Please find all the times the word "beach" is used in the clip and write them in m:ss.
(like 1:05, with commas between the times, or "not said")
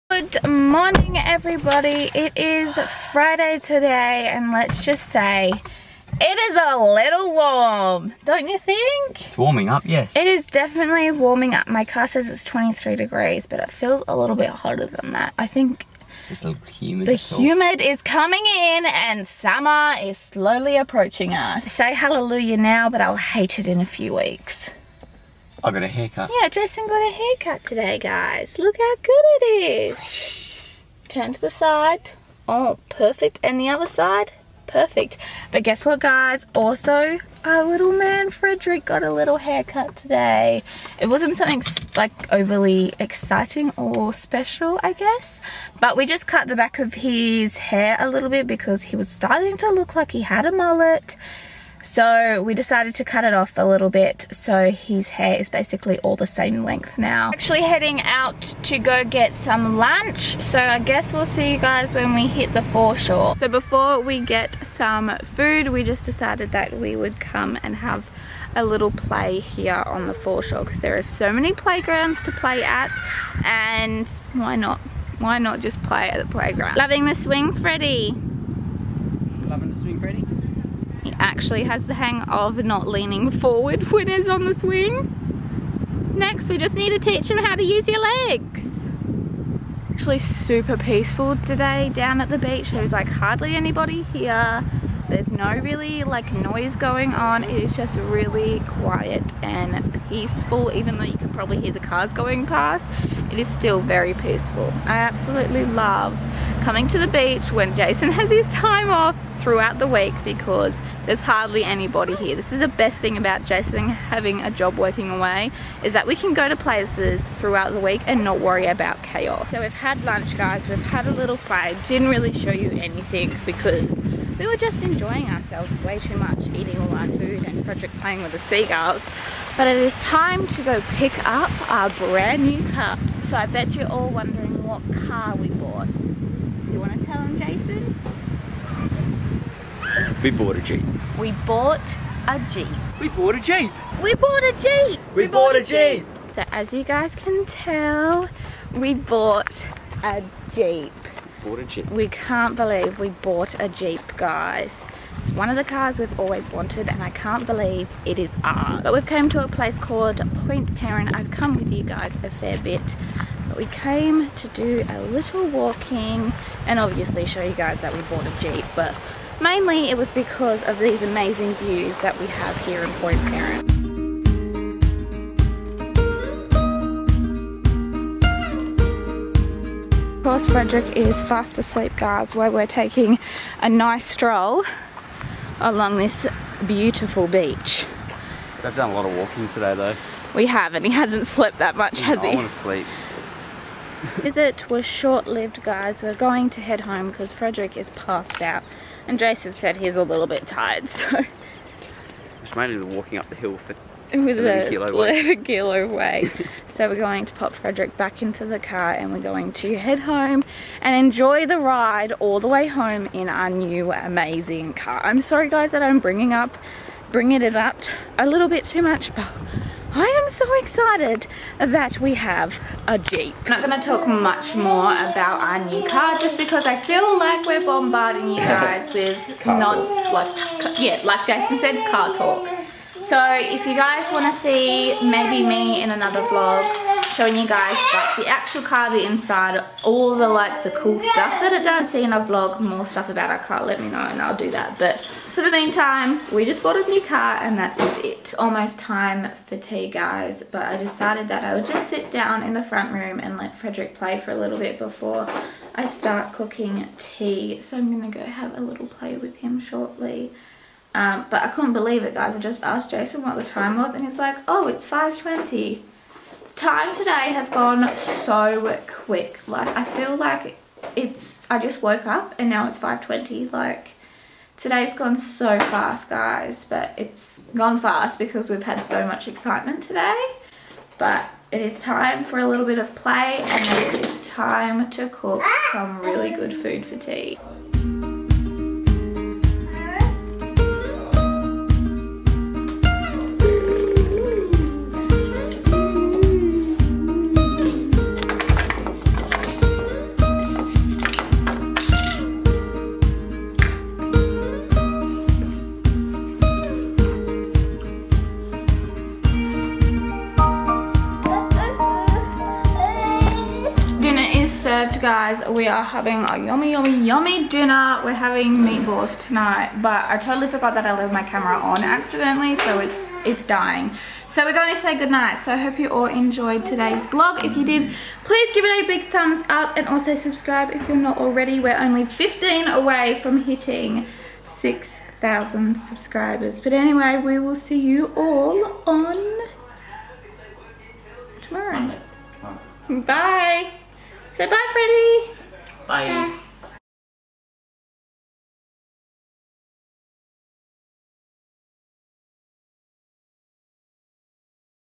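1:32, 1:47, 3:07.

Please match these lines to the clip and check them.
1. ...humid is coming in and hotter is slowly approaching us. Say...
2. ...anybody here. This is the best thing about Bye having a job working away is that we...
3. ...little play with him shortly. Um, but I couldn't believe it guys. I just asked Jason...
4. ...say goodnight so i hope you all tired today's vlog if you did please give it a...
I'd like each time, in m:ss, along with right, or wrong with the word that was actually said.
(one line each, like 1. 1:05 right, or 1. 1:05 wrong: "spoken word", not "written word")
1. 0:17 wrong: "summer", not "hotter"
2. 1:51 wrong: "Jason", not "Bye"
3. 4:18 right
4. 5:24 wrong: "enjoyed", not "tired".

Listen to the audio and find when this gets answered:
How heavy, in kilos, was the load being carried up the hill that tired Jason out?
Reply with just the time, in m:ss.
3:24.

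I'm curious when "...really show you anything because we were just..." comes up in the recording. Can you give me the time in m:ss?
2:02.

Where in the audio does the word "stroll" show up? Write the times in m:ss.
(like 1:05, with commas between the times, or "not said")
3:04.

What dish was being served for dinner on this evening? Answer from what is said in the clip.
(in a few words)
Meatballs.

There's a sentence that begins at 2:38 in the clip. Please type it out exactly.
But we've come to a place called Point Peron.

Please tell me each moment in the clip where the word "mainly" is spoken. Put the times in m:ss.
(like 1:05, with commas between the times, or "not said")
2:49, 3:22.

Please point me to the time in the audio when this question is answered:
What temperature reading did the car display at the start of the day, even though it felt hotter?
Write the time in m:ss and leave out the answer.
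0:12.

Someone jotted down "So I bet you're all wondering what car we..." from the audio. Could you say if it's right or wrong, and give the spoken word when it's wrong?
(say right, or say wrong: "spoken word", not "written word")
right.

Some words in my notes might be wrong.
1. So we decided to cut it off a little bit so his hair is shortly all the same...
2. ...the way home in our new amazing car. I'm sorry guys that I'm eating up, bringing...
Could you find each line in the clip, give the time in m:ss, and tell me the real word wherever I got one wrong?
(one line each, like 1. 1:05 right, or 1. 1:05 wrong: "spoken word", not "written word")
1. 0:51 wrong: "basically", not "shortly"
2. 3:32 wrong: "bringing", not "eating".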